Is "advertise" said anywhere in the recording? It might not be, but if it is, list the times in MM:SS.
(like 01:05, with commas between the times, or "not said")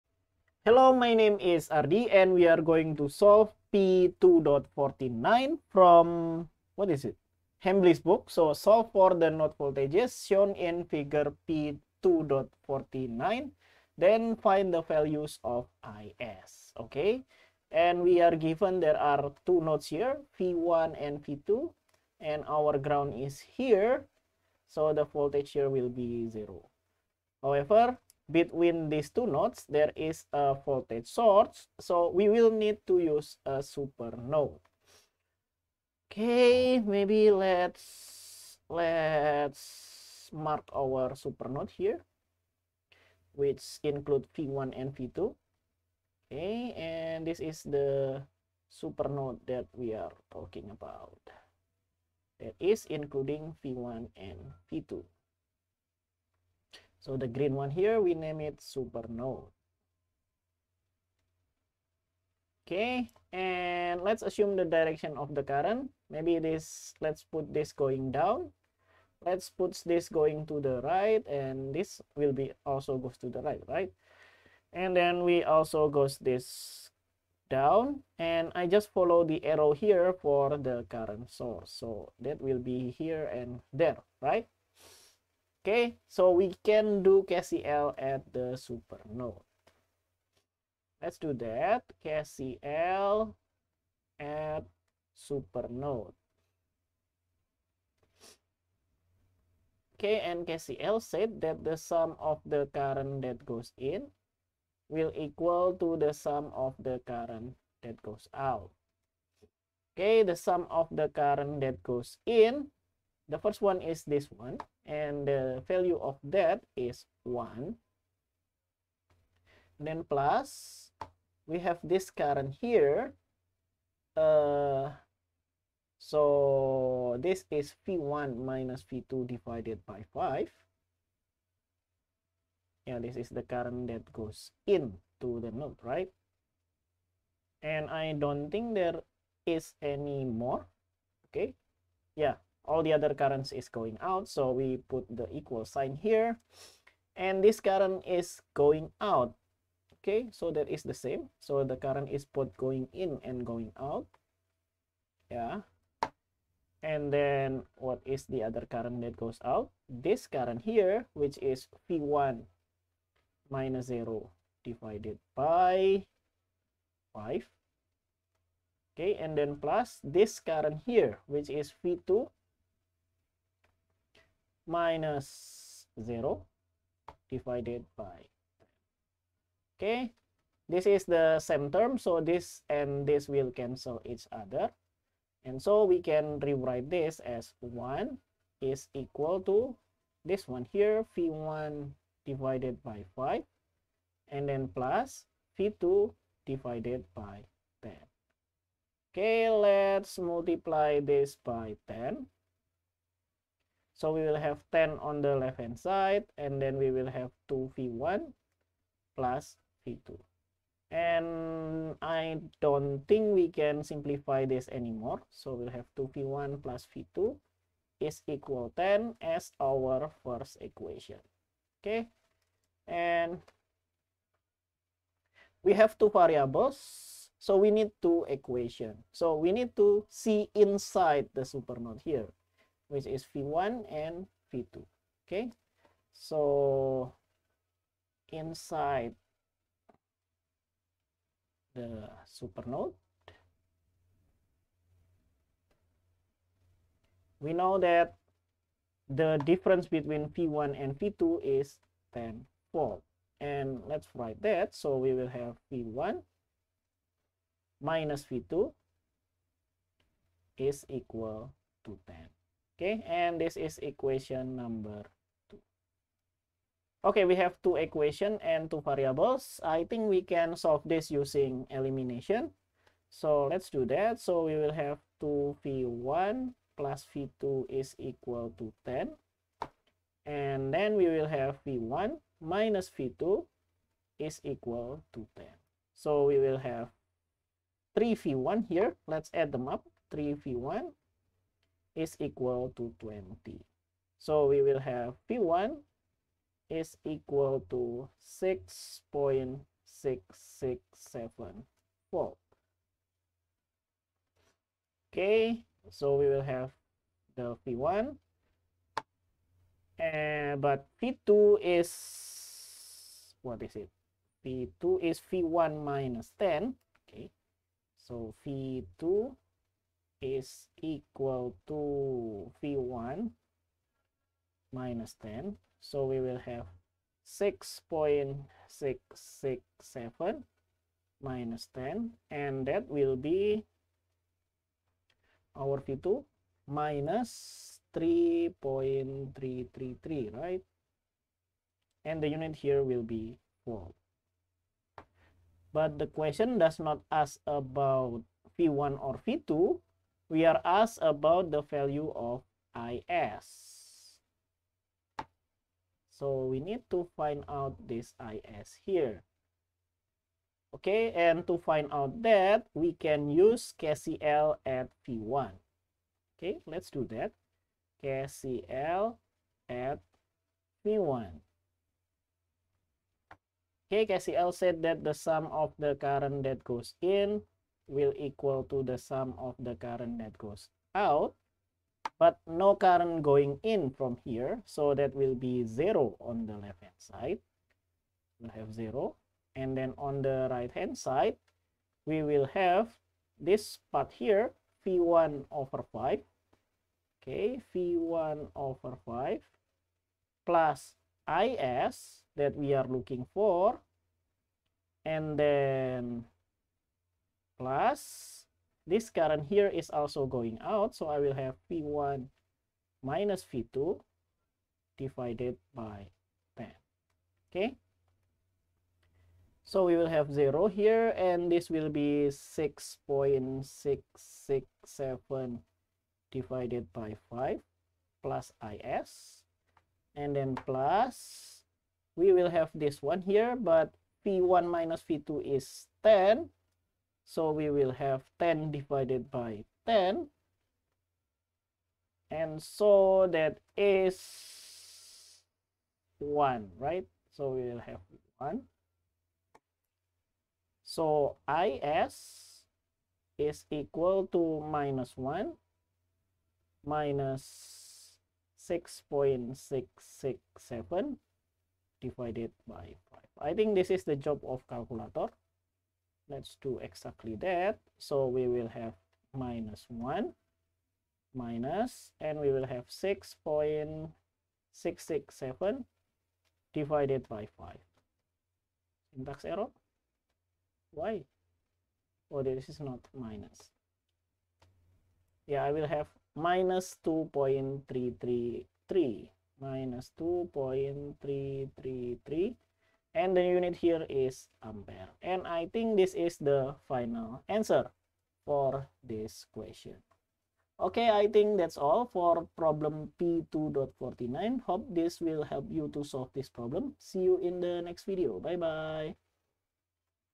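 not said.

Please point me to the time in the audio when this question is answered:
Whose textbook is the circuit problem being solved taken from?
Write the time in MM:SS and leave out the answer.
00:07.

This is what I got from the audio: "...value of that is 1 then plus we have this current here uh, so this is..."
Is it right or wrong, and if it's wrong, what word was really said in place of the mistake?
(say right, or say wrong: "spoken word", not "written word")
right.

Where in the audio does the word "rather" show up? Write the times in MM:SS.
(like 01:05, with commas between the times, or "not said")
not said.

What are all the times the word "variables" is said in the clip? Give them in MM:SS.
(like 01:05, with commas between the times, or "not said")
03:46, 04:28.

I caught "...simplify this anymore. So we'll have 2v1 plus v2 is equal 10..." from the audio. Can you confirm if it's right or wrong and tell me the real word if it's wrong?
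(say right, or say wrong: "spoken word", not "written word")
right.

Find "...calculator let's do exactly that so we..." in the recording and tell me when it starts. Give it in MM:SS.
07:44.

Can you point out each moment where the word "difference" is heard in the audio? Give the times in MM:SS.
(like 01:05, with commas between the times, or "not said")
04:09.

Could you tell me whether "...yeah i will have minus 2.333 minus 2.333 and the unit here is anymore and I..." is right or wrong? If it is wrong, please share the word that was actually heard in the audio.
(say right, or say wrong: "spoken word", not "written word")
wrong: "ampere", not "anymore".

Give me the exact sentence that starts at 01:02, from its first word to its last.
Okay, and let's assume the direction of the current.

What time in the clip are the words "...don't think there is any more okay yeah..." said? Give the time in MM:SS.
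02:18.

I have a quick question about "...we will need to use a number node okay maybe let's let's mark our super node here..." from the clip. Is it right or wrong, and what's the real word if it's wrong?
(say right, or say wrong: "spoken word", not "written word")
wrong: "super", not "number".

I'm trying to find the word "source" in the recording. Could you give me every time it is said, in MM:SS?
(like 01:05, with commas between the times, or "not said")
00:31, 01:21.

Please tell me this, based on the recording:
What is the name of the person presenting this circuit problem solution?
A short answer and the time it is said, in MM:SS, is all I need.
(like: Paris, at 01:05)
Ardi, at 00:01.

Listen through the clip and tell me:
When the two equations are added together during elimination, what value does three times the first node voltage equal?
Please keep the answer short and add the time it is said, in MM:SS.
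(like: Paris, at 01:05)
20, at 04:52.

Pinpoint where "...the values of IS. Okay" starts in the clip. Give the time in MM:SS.
00:14.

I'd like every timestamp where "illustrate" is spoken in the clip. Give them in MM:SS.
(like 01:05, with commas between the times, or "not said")
not said.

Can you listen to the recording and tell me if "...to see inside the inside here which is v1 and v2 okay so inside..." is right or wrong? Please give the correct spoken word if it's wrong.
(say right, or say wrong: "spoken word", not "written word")
wrong: "supernode", not "inside".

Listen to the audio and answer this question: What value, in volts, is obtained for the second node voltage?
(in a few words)
-3.333.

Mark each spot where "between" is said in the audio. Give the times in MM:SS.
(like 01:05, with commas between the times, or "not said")
00:28, 04:09.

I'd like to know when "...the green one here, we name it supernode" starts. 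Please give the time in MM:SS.
00:57.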